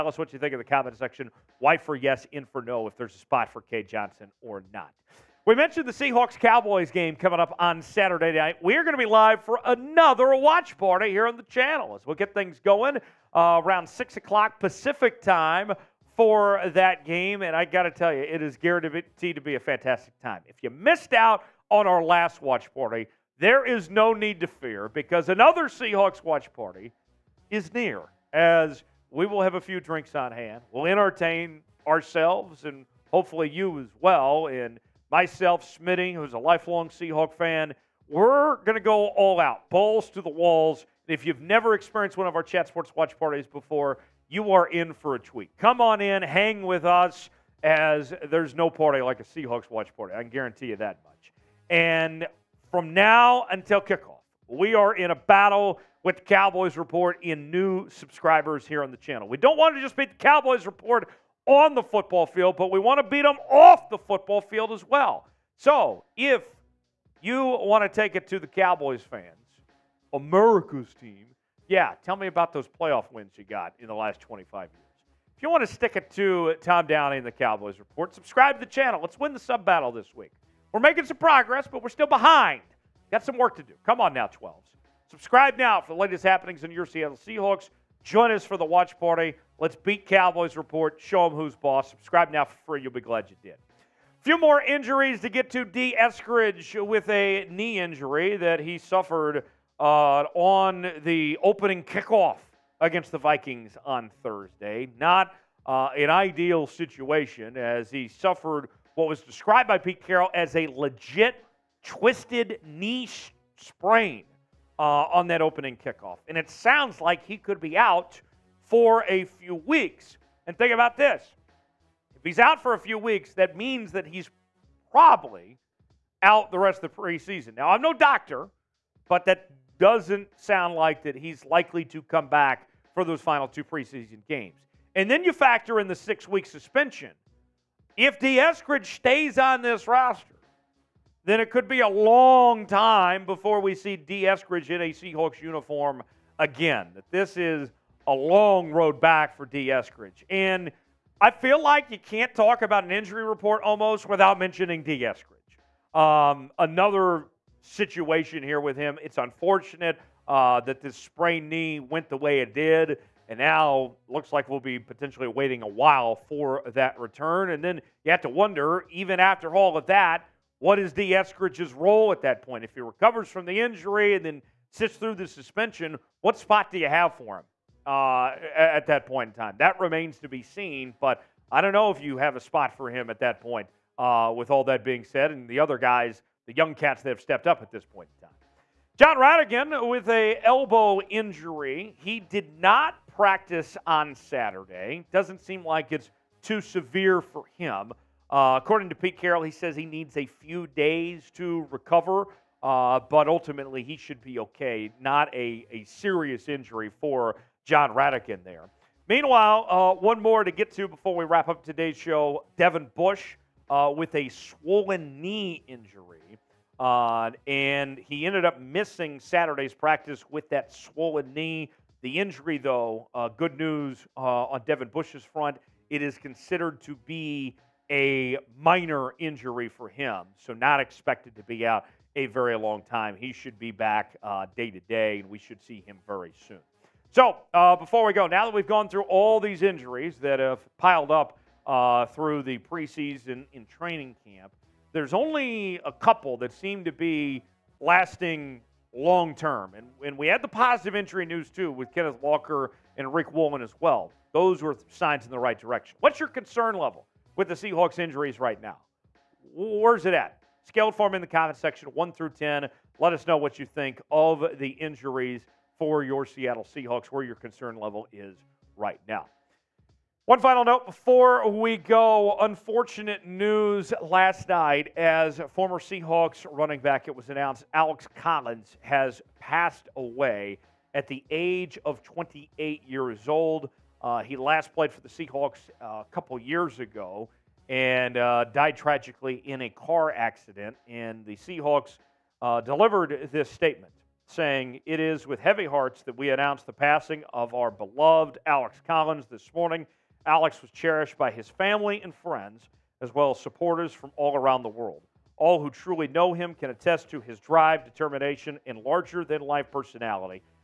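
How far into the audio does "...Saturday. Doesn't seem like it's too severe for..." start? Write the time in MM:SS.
03:14.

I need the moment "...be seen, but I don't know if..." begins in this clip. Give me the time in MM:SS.
03:00.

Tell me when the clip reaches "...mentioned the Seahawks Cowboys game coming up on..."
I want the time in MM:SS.
00:05.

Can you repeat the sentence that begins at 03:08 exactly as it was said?
Jon Rhattigan with a elbow injury.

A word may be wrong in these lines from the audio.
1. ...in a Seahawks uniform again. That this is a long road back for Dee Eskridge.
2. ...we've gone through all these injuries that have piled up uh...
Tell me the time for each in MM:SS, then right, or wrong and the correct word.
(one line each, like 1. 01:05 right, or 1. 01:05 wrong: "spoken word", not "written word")
1. 02:24 right
2. 03:58 right.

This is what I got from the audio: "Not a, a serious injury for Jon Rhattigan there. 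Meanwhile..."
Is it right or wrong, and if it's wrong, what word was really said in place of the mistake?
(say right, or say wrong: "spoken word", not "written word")
right.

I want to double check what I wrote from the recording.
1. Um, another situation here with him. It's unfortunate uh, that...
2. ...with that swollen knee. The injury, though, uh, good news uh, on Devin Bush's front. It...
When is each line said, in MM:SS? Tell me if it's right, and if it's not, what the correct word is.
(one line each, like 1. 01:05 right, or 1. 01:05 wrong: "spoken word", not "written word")
1. 02:35 right
2. 03:40 right.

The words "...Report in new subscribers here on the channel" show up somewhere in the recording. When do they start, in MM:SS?
00:56.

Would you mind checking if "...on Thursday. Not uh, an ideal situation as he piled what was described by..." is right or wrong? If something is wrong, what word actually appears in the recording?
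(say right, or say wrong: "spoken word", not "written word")
wrong: "suffered", not "piled".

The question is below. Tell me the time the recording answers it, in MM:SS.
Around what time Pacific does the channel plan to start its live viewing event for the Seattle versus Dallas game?
00:13.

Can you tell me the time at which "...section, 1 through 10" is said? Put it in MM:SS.
04:21.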